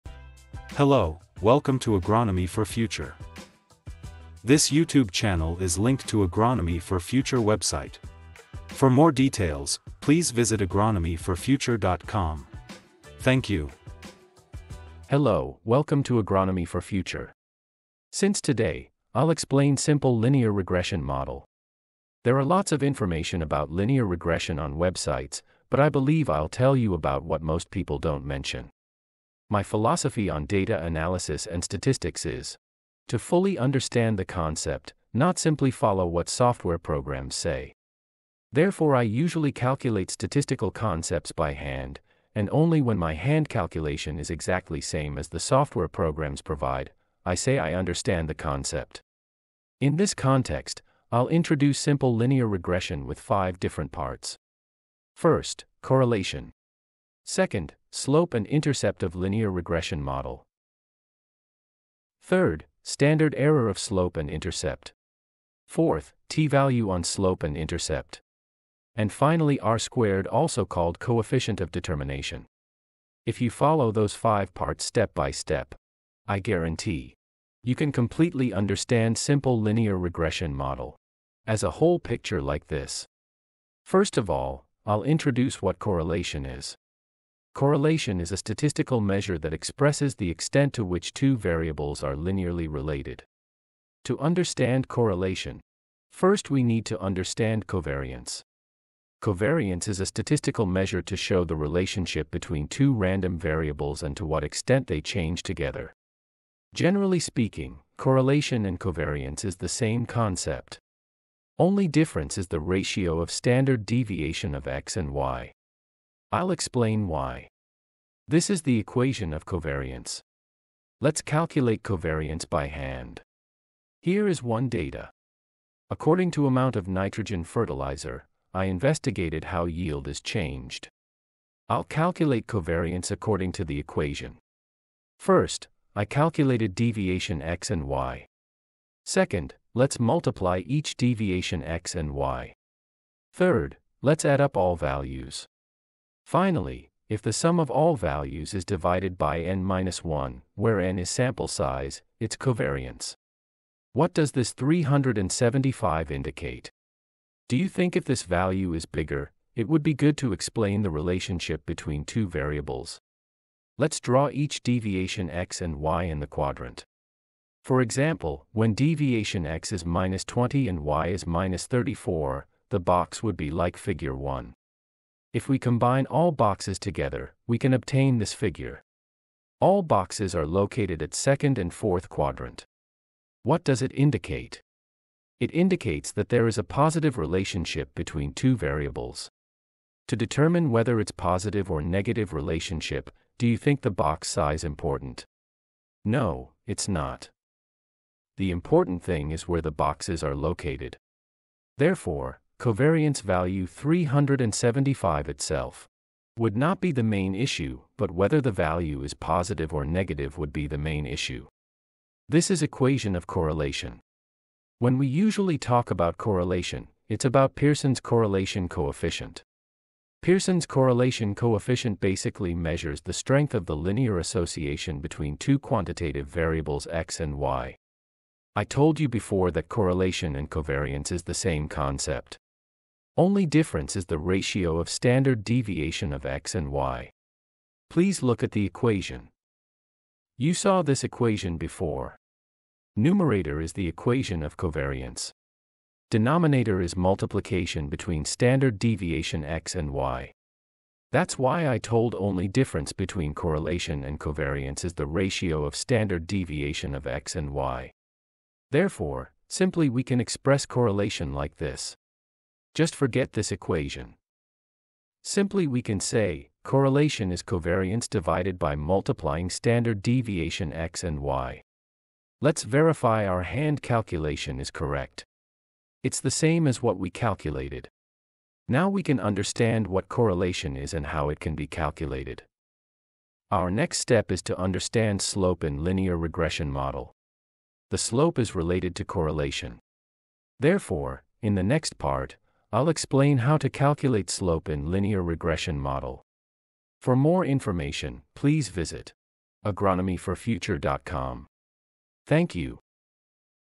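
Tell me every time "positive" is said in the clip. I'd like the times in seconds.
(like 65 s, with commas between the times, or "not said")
186 s, 191 s, 209 s.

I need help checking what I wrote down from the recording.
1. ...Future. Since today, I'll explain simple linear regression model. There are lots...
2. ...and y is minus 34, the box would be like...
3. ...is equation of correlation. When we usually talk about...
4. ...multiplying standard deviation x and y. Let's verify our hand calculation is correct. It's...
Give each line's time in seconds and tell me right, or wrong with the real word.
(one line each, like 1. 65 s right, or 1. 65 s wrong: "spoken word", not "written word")
1. 16 s right
2. 170 s right
3. 212 s right
4. 268 s right.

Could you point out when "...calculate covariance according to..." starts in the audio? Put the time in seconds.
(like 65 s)
131 s.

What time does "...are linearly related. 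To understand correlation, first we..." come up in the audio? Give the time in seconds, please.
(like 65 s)
92 s.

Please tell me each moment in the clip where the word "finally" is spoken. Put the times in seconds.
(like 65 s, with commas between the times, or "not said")
69 s, 146 s.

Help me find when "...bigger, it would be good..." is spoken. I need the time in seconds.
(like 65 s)
158 s.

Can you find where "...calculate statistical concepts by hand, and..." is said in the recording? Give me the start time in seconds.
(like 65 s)
39 s.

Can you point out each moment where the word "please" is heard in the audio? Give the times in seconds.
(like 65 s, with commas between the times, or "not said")
9 s, 237 s, 298 s.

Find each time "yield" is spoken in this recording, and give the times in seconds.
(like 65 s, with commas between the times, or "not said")
129 s.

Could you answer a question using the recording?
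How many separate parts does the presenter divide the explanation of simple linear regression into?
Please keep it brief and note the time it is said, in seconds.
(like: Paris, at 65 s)
5, at 53 s.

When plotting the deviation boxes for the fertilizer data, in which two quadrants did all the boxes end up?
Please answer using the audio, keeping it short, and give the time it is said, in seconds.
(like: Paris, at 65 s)
second and fourth, at 181 s.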